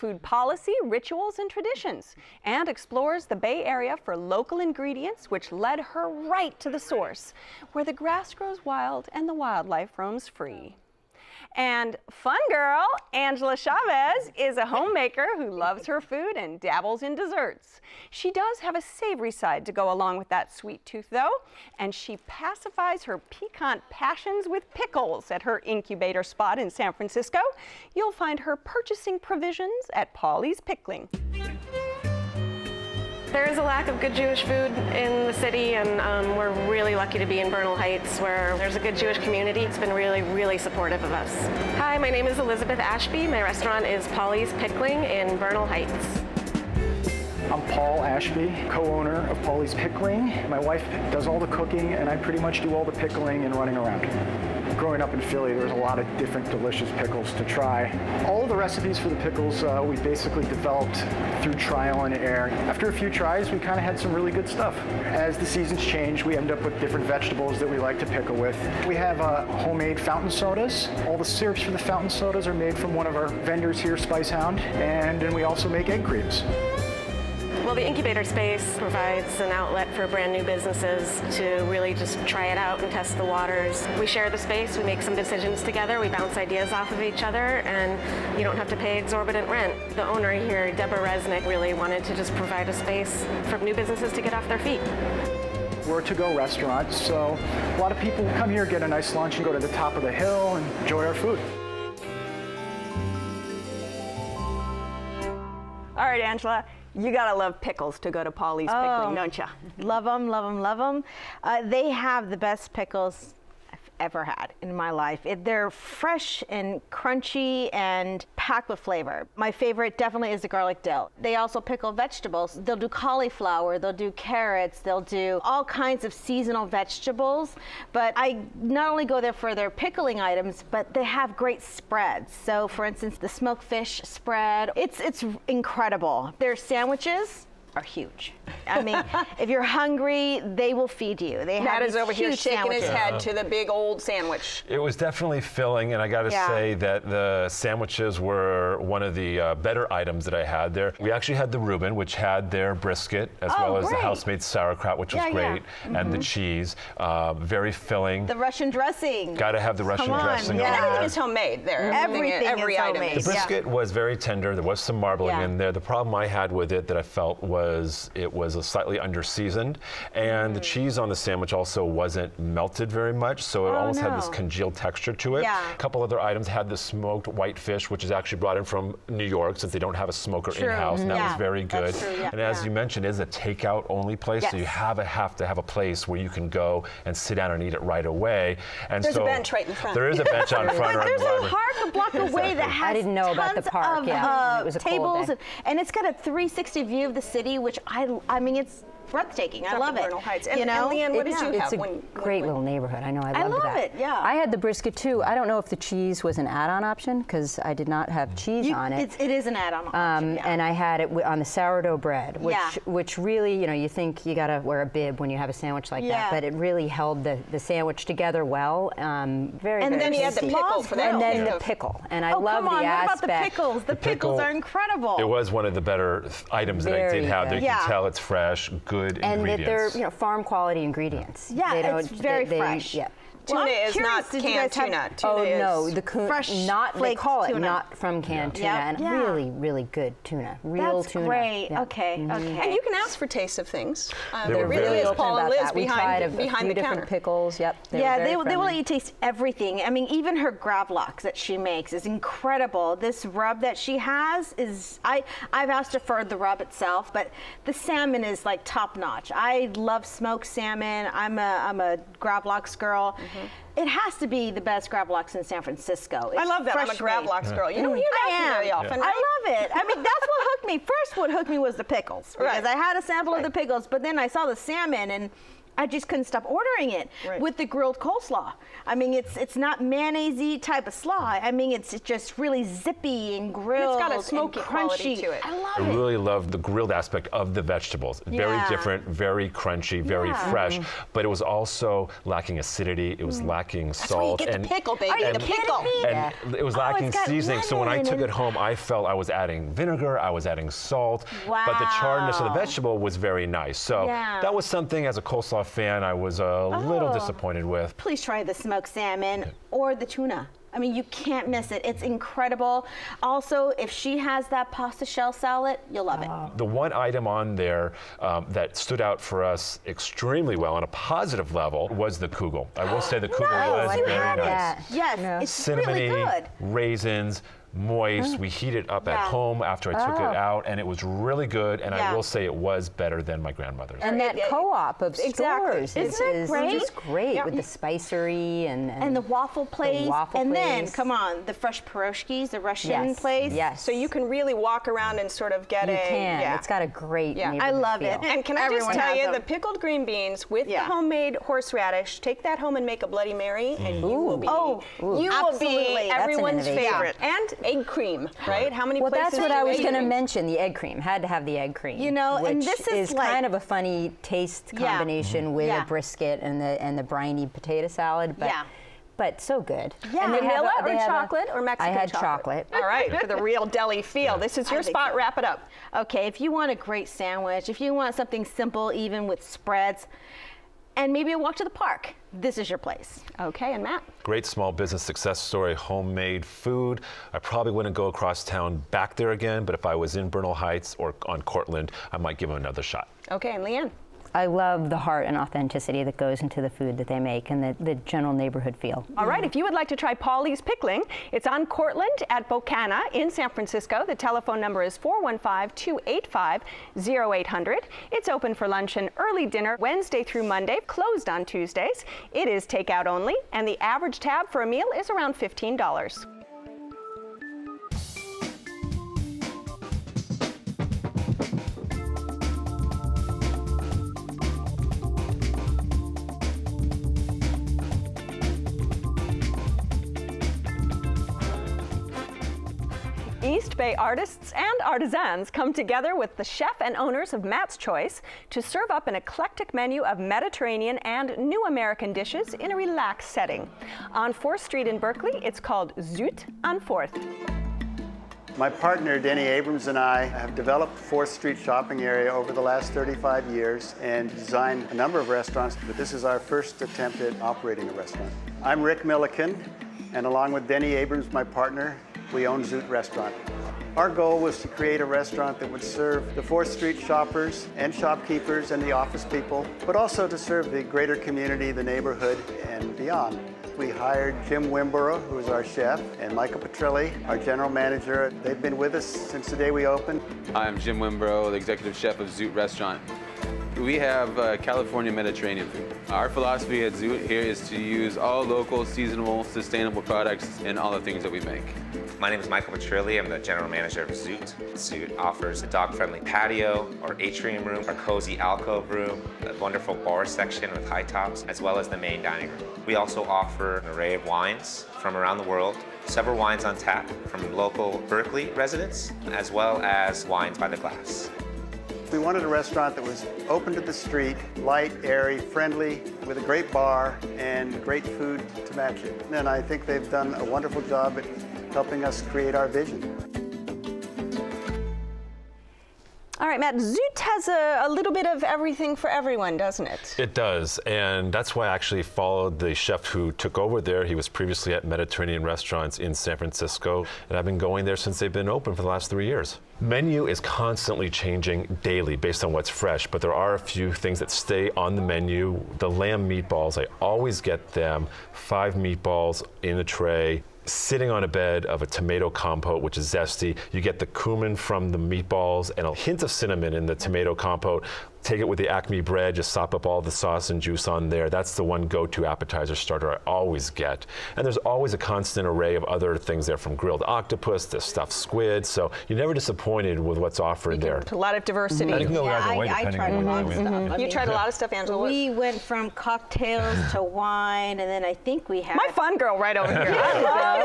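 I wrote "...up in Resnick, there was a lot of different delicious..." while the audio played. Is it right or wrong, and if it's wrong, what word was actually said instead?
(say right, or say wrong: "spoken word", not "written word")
wrong: "Philly", not "Resnick".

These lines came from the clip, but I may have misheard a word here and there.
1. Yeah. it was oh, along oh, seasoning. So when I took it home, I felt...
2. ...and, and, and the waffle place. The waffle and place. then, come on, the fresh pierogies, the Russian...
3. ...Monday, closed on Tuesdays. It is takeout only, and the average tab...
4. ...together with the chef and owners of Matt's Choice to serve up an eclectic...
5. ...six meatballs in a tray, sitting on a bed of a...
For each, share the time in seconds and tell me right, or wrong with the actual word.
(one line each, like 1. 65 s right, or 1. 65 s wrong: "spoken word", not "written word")
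1. 296 s wrong: "lacking", not "along"
2. 338 s right
3. 410 s right
4. 435 s right
5. 548 s wrong: "five", not "six".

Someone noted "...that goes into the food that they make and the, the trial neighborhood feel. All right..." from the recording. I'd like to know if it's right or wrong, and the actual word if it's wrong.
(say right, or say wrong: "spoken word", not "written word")
wrong: "general", not "trial".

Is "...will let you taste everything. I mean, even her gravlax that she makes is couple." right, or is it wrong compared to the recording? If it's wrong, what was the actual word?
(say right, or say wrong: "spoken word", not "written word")
wrong: "incredible", not "couple".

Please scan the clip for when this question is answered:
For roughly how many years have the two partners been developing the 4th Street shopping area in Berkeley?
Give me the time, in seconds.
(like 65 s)
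452 s.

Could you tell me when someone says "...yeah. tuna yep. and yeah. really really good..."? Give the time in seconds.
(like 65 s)
238 s.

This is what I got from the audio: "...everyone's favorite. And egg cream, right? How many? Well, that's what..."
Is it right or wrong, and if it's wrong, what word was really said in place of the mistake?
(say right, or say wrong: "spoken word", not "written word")
right.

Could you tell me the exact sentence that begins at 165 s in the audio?
The problem I had with it that I felt was it was was slightly underseasoned, and mm.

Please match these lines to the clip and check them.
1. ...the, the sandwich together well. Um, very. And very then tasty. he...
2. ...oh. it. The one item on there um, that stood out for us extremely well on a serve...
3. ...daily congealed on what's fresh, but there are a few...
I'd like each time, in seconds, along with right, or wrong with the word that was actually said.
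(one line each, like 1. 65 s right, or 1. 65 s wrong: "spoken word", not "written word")
1. 217 s right
2. 316 s wrong: "positive", not "serve"
3. 541 s wrong: "based", not "congealed".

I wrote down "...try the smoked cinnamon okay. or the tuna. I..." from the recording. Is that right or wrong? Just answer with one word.
wrong.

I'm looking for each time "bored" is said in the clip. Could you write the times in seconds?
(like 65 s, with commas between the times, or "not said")
not said.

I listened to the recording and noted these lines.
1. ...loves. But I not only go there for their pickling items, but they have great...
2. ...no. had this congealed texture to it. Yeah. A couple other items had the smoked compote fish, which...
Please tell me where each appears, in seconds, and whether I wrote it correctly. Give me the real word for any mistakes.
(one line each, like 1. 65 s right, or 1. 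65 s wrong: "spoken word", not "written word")
1. 126 s wrong: "vegetables", not "loves"
2. 174 s wrong: "white", not "compote".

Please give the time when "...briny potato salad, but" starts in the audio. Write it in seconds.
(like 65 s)
367 s.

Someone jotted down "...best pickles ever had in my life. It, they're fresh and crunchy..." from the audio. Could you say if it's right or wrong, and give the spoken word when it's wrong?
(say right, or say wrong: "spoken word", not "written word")
right.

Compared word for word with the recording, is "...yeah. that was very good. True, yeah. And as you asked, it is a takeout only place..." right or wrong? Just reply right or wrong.
wrong.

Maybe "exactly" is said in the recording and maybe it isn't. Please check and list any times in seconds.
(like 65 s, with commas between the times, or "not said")
192 s, 335 s.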